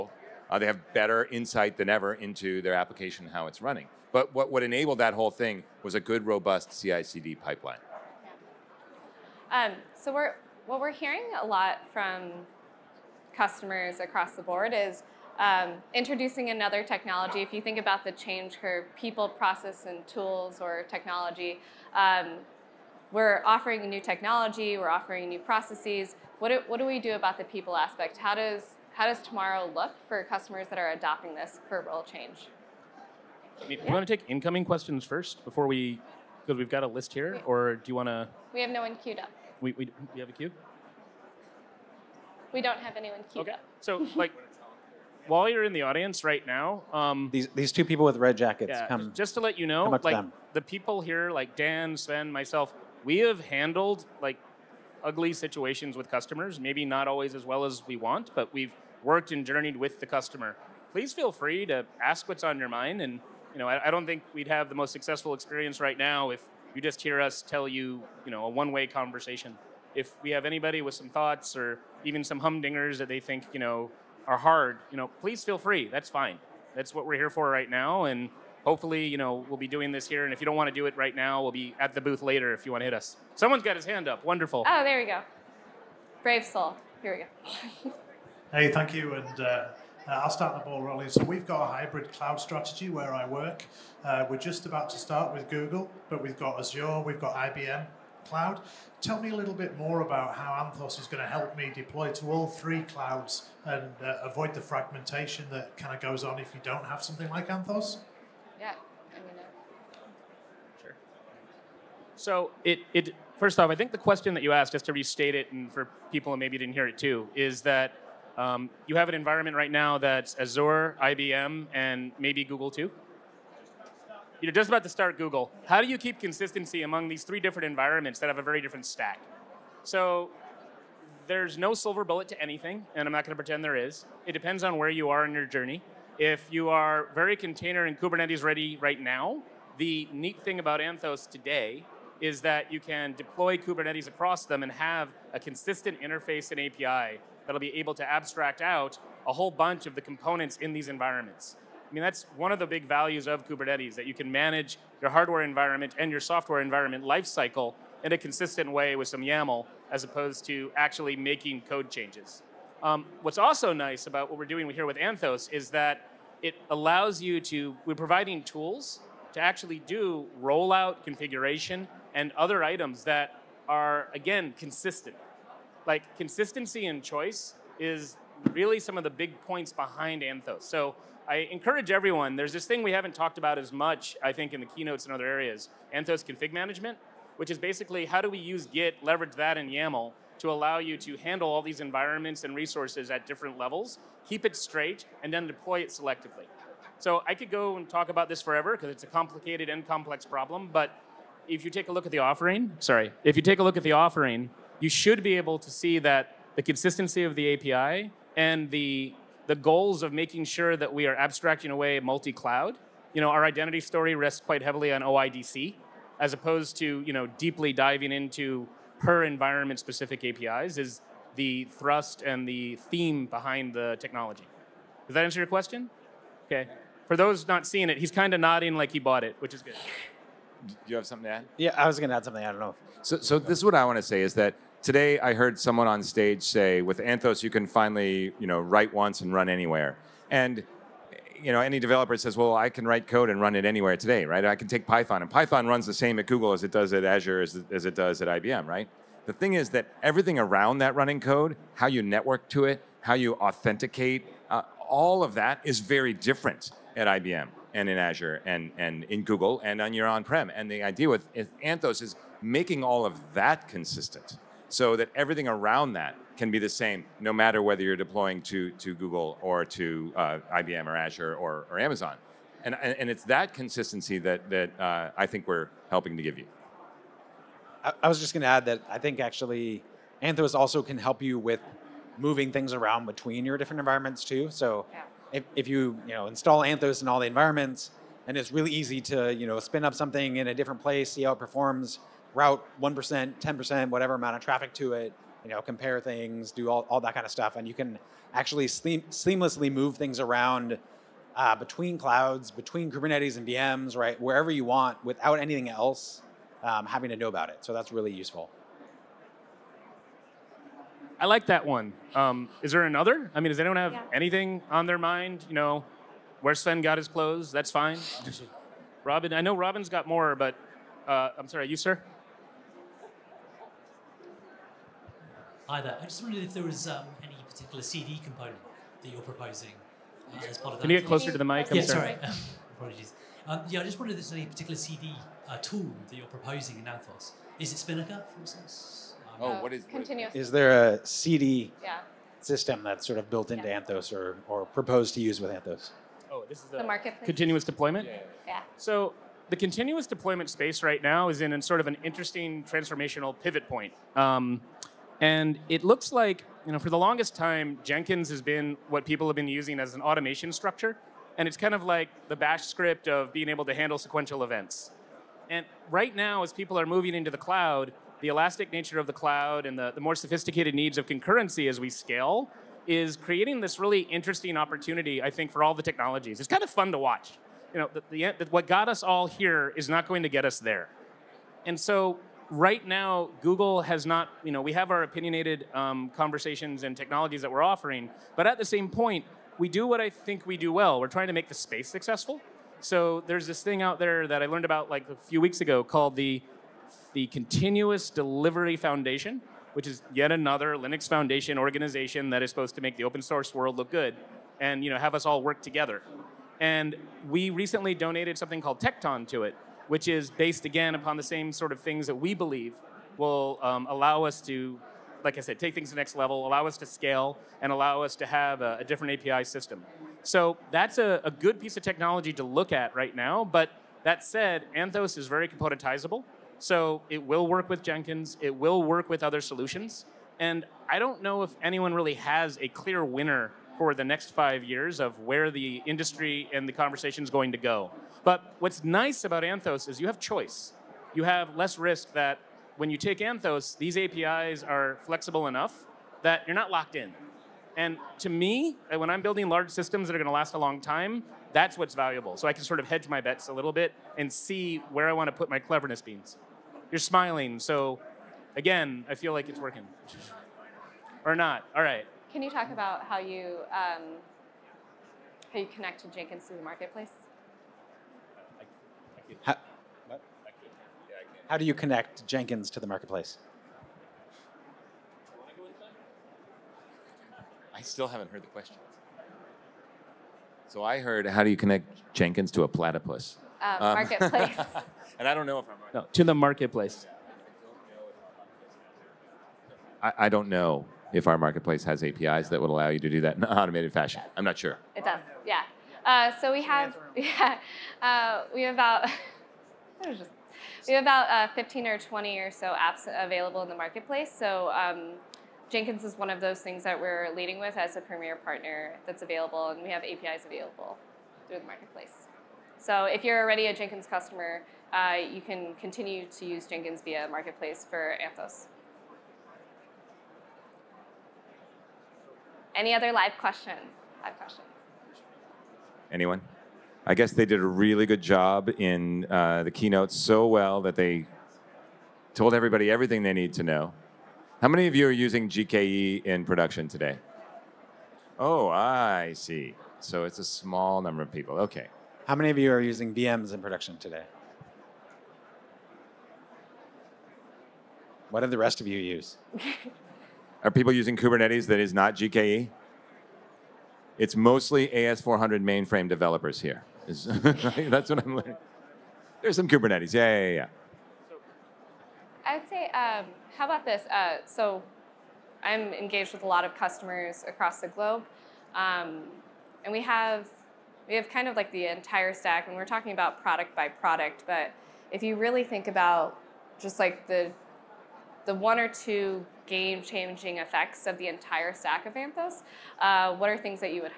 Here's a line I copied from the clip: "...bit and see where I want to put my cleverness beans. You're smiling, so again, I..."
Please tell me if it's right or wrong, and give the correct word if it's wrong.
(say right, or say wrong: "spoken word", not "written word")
right.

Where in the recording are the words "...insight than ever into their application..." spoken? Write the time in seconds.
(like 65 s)
1 s.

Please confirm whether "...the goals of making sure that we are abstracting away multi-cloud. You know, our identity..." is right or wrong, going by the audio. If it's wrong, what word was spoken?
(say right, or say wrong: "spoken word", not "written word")
right.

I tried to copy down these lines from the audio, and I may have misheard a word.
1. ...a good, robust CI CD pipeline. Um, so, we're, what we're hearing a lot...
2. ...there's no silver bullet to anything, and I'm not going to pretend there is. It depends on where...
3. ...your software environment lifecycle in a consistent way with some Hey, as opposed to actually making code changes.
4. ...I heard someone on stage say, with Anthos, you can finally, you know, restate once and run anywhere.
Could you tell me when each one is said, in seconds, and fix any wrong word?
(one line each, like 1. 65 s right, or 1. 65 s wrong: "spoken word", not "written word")
1. 5 s right
2. 131 s right
3. 156 s wrong: "YAML", not "Hey"
4. 235 s wrong: "write", not "restate".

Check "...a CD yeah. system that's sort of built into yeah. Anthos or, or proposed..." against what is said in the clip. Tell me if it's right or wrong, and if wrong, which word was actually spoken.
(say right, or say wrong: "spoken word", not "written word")
right.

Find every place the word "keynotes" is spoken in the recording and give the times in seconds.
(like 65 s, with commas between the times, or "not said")
184 s, 529 s.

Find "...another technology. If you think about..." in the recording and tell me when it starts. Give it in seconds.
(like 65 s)
16 s.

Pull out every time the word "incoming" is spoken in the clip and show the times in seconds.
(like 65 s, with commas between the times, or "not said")
34 s.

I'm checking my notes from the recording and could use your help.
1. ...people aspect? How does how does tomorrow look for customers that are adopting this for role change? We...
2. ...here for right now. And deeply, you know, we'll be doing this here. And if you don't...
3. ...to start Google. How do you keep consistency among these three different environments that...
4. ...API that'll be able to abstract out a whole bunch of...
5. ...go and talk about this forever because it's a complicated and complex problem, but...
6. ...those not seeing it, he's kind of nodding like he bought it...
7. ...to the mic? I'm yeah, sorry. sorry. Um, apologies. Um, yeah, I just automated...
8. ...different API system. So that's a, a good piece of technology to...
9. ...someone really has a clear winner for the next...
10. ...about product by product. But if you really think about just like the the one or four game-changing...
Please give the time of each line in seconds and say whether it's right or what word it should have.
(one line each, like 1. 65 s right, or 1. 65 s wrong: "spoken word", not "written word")
1. 27 s right
2. 77 s wrong: "hopefully", not "deeply"
3. 124 s right
4. 146 s right
5. 197 s right
6. 227 s right
7. 331 s wrong: "wondered", not "automated"
8. 418 s right
9. 431 s wrong: "anyone", not "someone"
10. 573 s wrong: "two", not "four".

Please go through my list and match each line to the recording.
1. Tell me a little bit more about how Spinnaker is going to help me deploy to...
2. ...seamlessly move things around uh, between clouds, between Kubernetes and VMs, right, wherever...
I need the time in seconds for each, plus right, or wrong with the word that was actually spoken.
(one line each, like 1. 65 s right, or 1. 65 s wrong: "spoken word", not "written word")
1. 99 s wrong: "Anthos", not "Spinnaker"
2. 299 s right.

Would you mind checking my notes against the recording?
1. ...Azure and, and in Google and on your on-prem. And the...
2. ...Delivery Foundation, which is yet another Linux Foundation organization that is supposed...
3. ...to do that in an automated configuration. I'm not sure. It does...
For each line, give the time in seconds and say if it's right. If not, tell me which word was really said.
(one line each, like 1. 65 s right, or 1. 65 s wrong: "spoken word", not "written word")
1. 257 s right
2. 398 s right
3. 492 s wrong: "fashion", not "configuration".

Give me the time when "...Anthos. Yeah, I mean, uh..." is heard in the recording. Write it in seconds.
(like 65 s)
107 s.